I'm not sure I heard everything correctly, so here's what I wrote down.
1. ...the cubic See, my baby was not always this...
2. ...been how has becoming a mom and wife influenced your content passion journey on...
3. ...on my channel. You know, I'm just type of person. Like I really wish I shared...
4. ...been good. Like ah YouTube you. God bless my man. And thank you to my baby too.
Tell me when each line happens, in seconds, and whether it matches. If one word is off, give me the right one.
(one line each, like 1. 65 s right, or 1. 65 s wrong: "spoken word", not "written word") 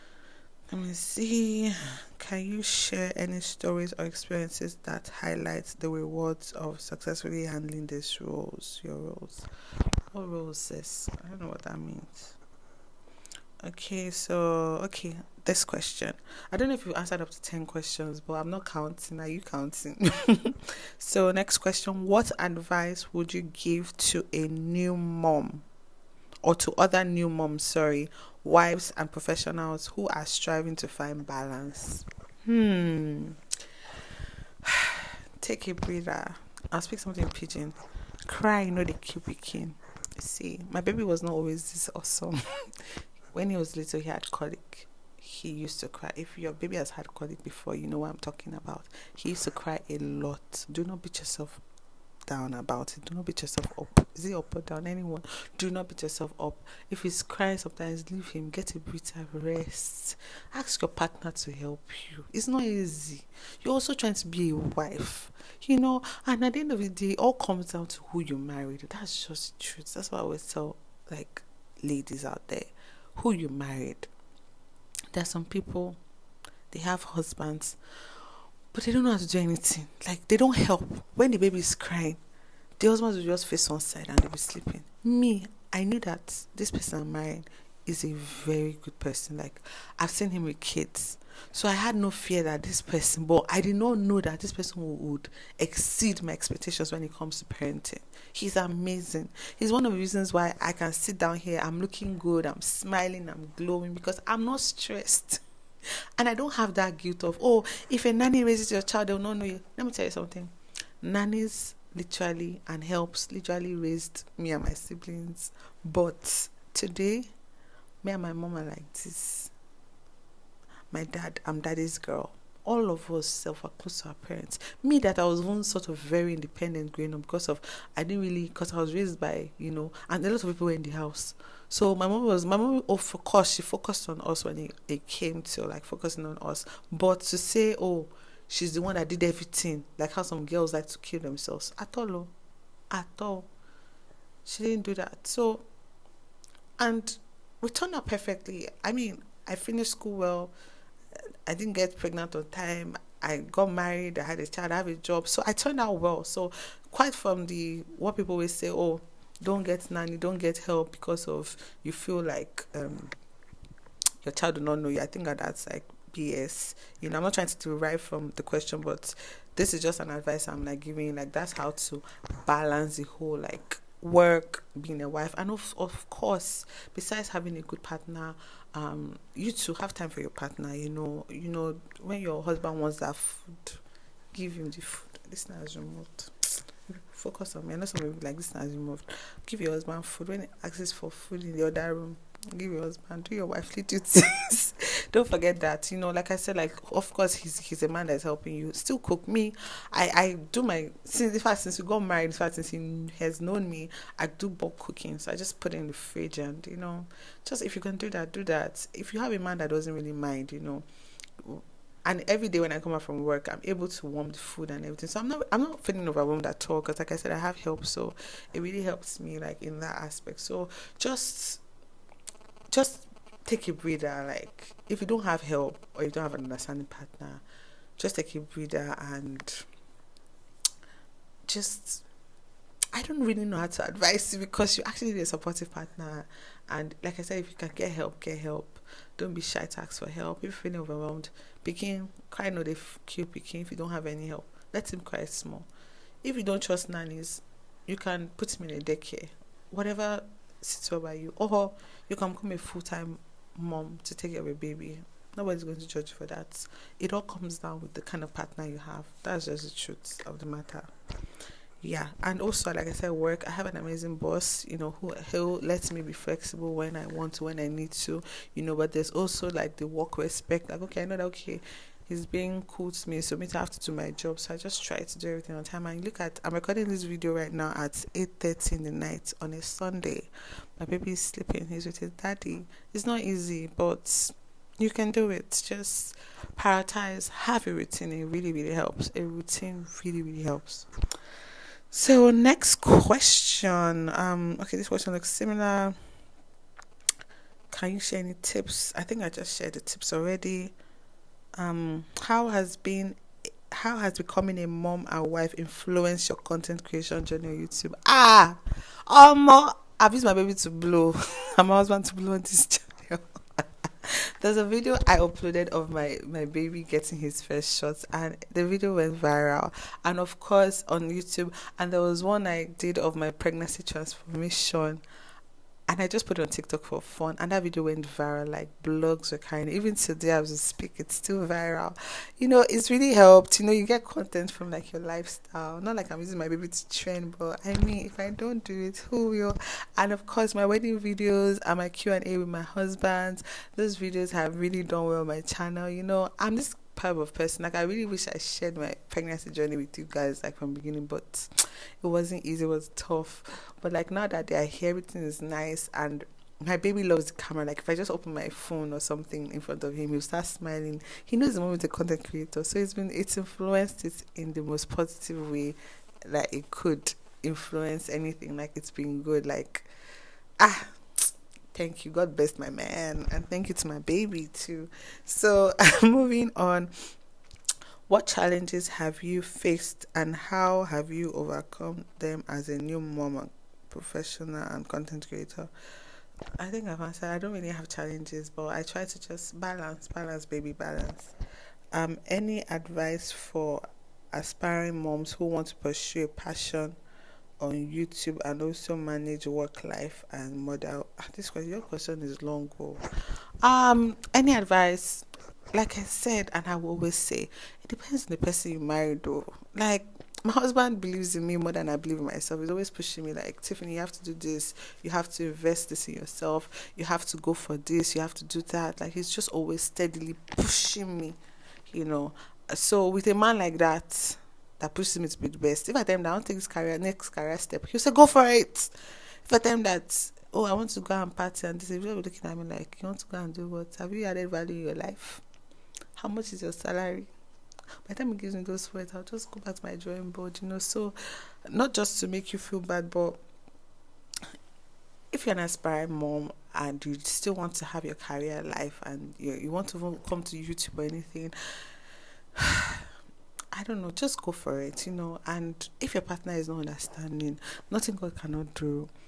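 1. 38 s right
2. 302 s wrong: "creation", not "passion"
3. 345 s right
4. 368 s wrong: "Thank", not "YouTube".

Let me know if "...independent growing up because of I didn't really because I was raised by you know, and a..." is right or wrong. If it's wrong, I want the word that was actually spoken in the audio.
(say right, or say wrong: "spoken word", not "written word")
right.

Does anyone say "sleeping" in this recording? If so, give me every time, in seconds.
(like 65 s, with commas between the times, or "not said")
84 s, 281 s.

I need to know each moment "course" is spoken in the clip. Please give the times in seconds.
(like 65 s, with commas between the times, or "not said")
133 s, 176 s, 197 s, 320 s, 340 s.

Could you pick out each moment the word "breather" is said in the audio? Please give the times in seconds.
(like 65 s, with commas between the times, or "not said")
35 s, 223 s, 228 s.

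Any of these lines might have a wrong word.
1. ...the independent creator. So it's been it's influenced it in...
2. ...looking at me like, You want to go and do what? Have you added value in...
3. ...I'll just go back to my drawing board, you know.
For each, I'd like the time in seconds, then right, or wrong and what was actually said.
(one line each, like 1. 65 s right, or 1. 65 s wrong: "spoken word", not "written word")
1. 361 s wrong: "content", not "independent"
2. 432 s right
3. 439 s right.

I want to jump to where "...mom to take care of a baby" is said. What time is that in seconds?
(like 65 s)
253 s.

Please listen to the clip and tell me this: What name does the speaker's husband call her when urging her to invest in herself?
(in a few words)
Tiffany.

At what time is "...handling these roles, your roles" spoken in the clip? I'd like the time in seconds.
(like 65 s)
7 s.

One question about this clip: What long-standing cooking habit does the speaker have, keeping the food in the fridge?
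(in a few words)
Bulk cooking.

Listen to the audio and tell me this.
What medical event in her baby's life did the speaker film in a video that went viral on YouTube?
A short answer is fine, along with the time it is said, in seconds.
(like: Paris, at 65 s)
His first shots, at 317 s.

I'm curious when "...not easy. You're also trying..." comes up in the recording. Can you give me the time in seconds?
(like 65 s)
62 s.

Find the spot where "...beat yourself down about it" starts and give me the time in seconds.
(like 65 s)
51 s.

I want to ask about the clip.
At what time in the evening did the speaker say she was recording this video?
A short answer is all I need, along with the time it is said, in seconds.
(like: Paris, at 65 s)
8:30, at 278 s.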